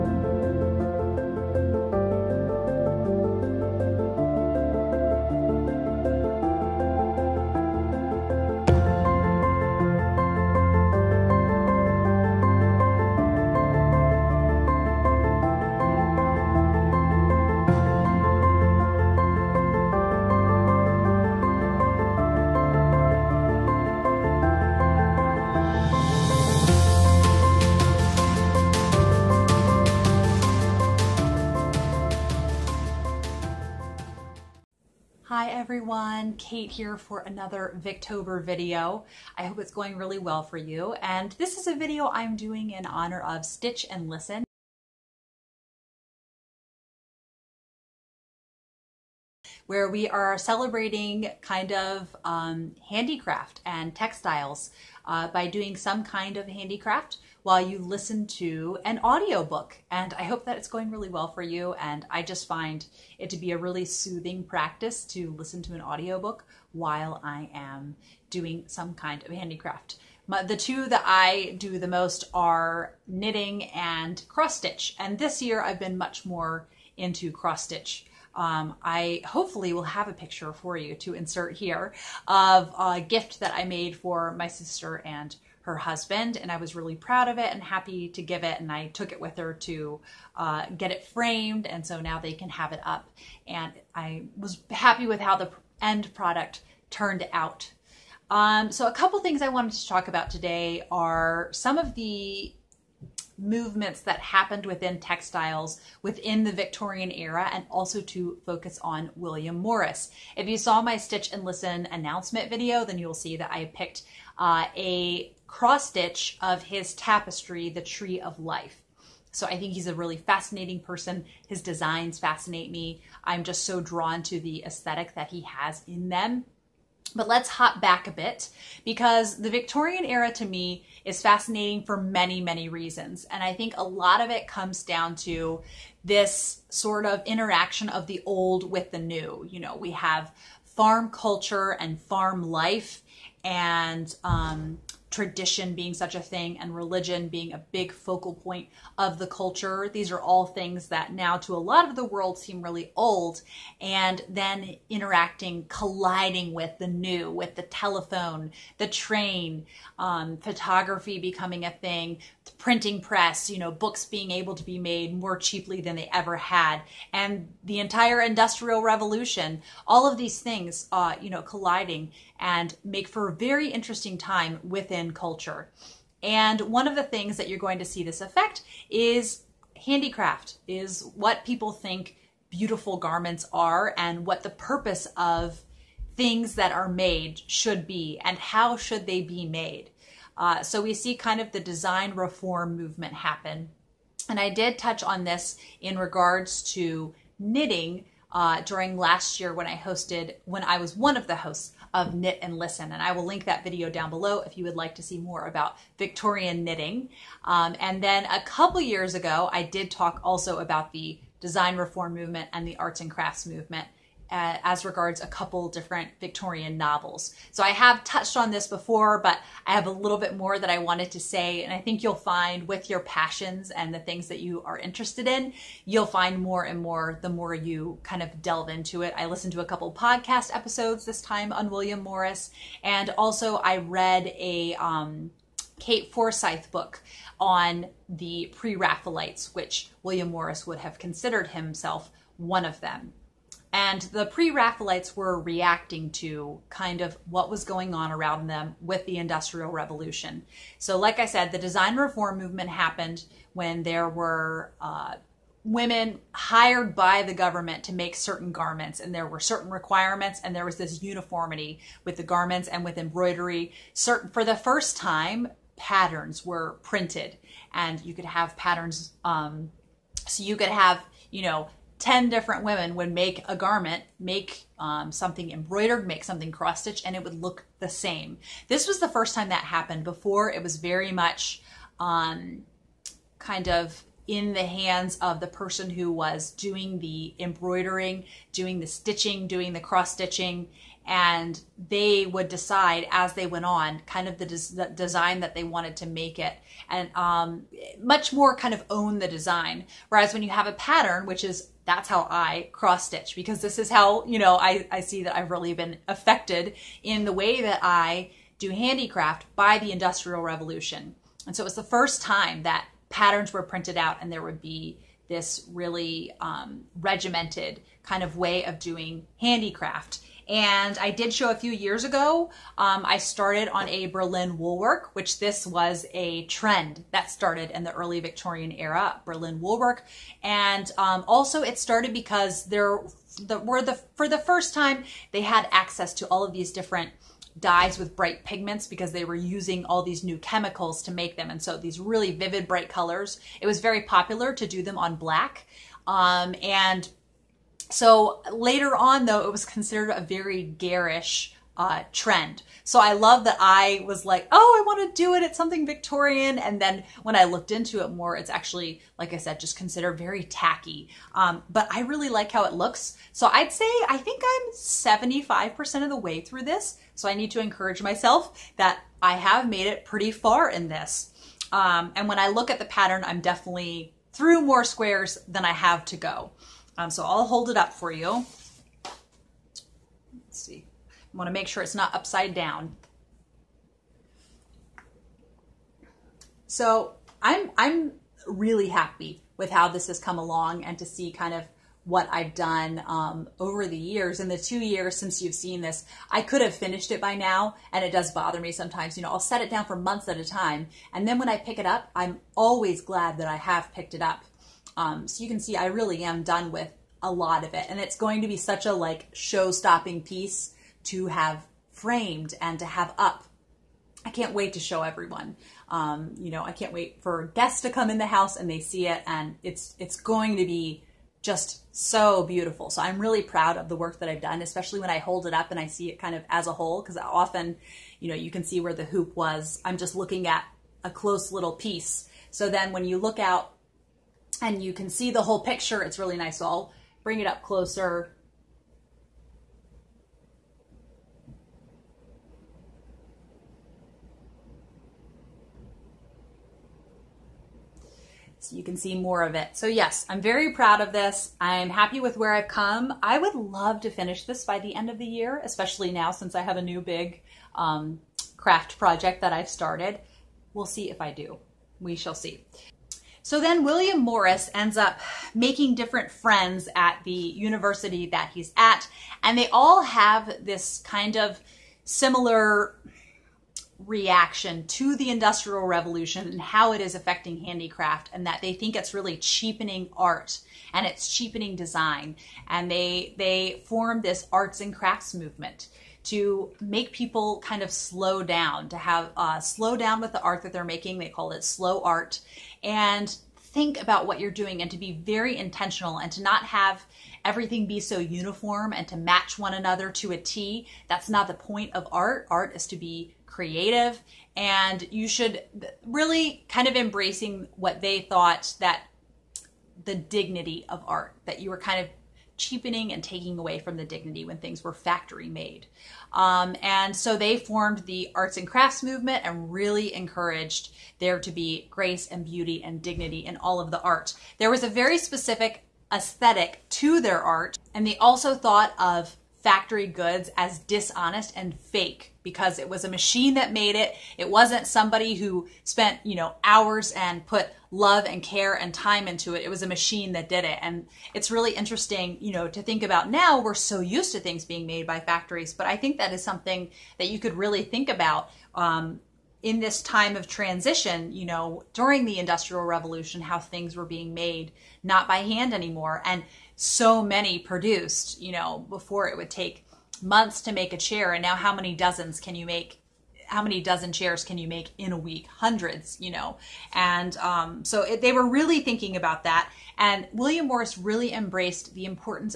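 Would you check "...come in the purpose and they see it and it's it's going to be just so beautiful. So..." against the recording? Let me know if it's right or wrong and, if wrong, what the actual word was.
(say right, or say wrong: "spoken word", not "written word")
wrong: "house", not "purpose".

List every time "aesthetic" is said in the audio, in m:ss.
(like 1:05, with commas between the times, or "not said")
2:04, 8:46.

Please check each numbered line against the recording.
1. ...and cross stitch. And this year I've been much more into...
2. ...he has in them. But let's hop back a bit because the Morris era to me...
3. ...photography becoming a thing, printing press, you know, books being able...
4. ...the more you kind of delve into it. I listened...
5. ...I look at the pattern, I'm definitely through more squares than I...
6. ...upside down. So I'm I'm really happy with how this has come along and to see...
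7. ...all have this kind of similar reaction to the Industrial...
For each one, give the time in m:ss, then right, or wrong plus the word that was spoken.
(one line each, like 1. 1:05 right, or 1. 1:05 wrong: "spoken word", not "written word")
1. 1:13 right
2. 2:05 wrong: "Victorian", not "Morris"
3. 2:40 right
4. 3:47 right
5. 6:12 right
6. 6:22 right
7. 7:49 right.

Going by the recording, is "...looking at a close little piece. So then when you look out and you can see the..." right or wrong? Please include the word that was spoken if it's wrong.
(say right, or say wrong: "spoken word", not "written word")
right.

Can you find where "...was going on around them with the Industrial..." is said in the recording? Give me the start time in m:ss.
4:07.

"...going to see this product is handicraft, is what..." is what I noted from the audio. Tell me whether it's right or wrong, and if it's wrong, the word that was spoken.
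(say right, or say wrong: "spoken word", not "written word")
wrong: "affect", not "product".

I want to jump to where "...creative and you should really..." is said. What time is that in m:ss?
8:23.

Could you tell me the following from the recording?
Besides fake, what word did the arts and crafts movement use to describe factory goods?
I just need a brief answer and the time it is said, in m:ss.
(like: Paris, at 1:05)
Dishonest, at 8:50.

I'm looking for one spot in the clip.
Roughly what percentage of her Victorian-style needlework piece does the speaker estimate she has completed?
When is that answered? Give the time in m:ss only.
6:04.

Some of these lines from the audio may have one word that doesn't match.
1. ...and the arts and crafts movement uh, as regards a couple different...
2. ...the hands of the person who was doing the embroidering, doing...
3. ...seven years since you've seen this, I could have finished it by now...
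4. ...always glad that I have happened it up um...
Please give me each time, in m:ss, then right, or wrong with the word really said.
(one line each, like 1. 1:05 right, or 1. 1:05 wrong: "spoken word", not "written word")
1. 3:32 right
2. 4:44 right
3. 6:34 wrong: "two", not "seven"
4. 6:42 wrong: "picked", not "happened".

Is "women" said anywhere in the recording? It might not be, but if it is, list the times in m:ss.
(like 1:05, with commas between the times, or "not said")
4:15, 4:32.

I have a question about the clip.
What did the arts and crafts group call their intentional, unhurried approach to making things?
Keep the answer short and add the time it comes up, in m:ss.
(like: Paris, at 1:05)
Slow art, at 8:11.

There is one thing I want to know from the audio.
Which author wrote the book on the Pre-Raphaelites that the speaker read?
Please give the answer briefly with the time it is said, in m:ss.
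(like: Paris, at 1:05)
Kate Forsyth, at 3:55.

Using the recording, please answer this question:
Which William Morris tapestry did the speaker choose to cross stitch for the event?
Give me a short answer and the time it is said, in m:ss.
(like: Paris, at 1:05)
The Tree of Life, at 1:57.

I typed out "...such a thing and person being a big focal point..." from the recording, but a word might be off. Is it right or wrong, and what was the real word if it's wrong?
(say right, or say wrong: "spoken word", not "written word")
wrong: "religion", not "person".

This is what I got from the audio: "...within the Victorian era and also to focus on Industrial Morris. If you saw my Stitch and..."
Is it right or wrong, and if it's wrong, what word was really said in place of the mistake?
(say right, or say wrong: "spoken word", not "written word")
wrong: "William", not "Industrial".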